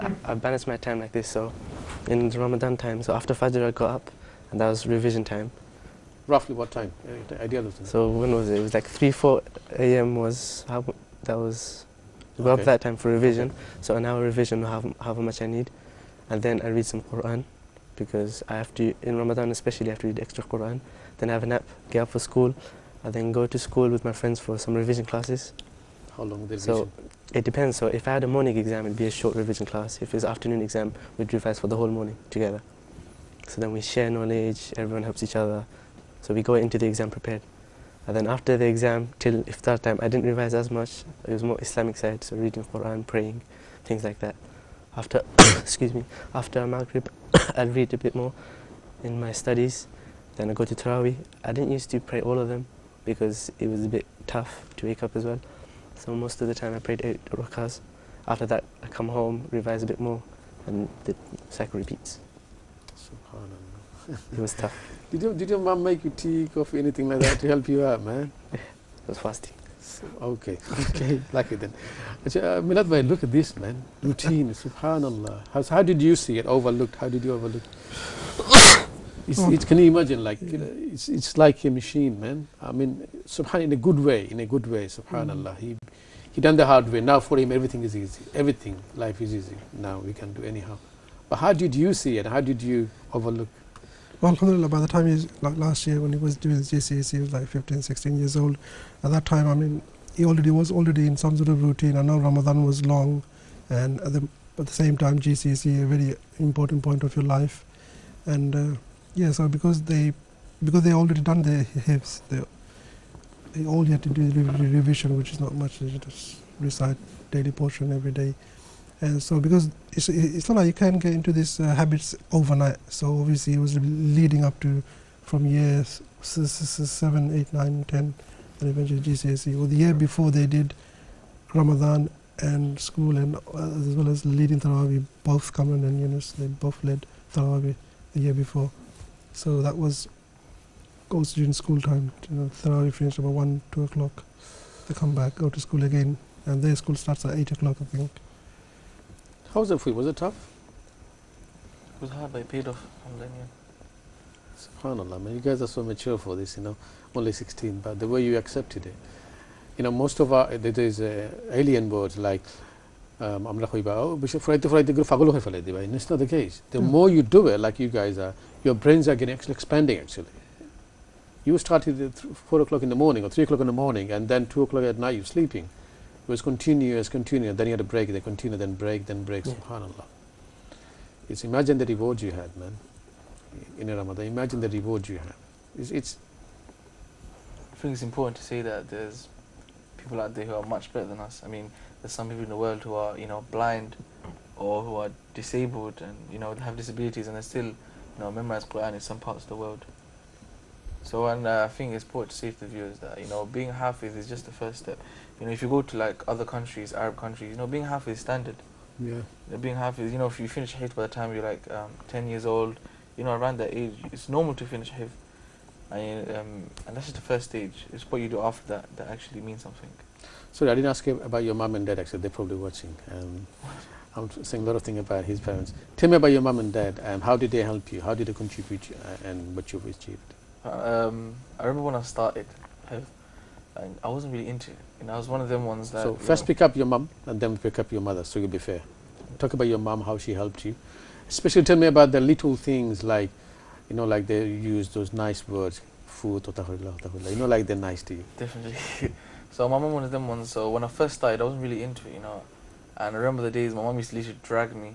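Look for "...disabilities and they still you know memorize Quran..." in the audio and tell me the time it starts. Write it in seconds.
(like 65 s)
196 s.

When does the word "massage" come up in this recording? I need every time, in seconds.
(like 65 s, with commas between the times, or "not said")
not said.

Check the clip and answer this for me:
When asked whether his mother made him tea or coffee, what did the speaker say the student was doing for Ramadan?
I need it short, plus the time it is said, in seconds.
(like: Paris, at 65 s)
fasting, at 69 s.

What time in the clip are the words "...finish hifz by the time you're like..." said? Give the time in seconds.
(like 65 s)
210 s.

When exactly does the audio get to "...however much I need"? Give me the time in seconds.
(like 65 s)
15 s.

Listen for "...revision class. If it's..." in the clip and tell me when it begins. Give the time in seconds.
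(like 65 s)
29 s.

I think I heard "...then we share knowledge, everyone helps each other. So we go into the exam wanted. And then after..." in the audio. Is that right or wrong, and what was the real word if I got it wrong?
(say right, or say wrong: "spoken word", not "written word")
wrong: "prepared", not "wanted".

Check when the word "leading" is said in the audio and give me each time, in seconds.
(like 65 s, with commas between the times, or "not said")
123 s, 134 s.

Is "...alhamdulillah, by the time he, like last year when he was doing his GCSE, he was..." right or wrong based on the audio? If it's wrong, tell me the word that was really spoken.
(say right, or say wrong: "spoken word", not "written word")
right.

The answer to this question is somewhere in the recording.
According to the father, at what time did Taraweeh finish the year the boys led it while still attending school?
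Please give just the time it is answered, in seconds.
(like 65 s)
143 s.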